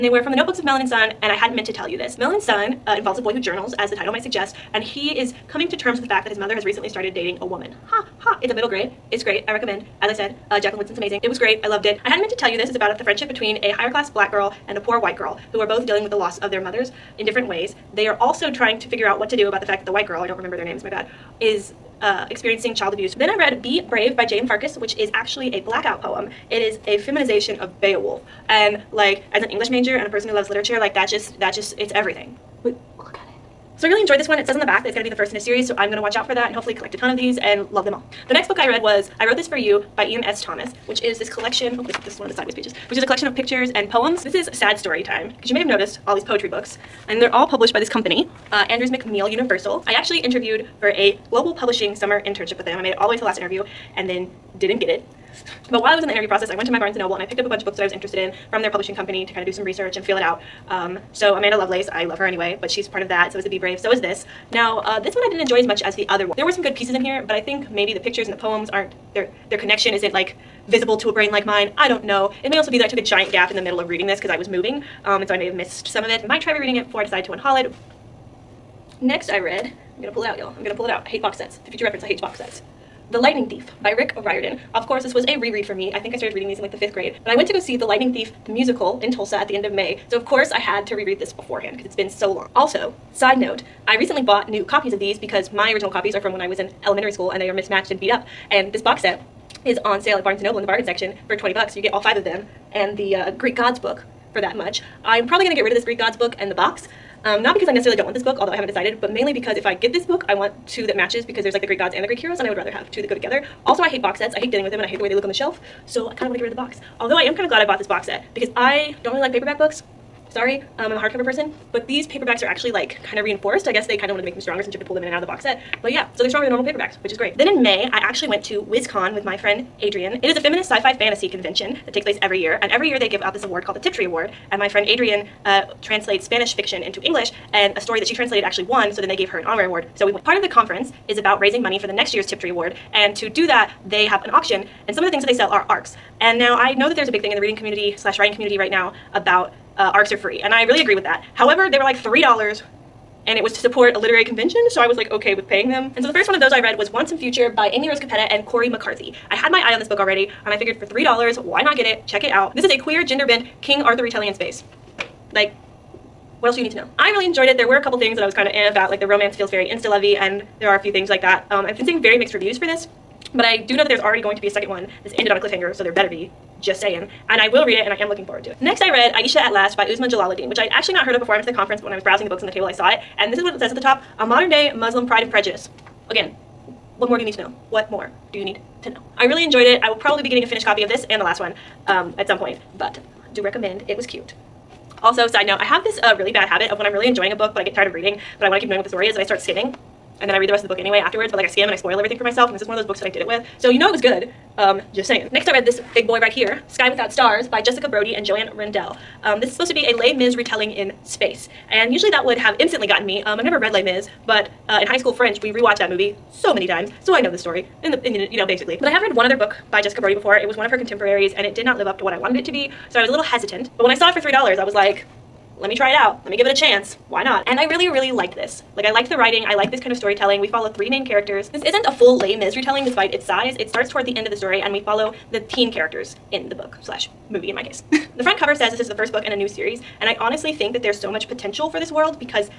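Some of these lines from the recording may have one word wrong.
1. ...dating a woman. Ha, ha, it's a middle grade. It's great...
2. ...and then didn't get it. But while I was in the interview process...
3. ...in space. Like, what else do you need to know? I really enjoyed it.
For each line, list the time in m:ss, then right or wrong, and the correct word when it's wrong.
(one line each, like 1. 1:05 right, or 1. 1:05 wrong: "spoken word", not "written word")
1. 0:07 right
2. 0:53 right
3. 2:44 right.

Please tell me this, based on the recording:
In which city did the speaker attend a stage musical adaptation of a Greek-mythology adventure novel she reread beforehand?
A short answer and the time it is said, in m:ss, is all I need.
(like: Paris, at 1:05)
Tulsa, at 1:29.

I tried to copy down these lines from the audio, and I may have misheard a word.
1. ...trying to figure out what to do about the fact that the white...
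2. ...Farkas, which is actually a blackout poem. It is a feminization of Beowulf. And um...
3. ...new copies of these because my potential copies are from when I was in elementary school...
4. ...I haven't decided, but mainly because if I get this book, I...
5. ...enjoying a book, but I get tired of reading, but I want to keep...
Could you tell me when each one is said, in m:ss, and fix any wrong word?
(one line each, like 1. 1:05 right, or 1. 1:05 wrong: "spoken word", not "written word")
1. 0:18 right
2. 0:24 right
3. 1:34 wrong: "original", not "potential"
4. 1:48 right
5. 3:17 right.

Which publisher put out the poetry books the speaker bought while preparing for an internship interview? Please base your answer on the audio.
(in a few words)
Andrews McMeel Universal.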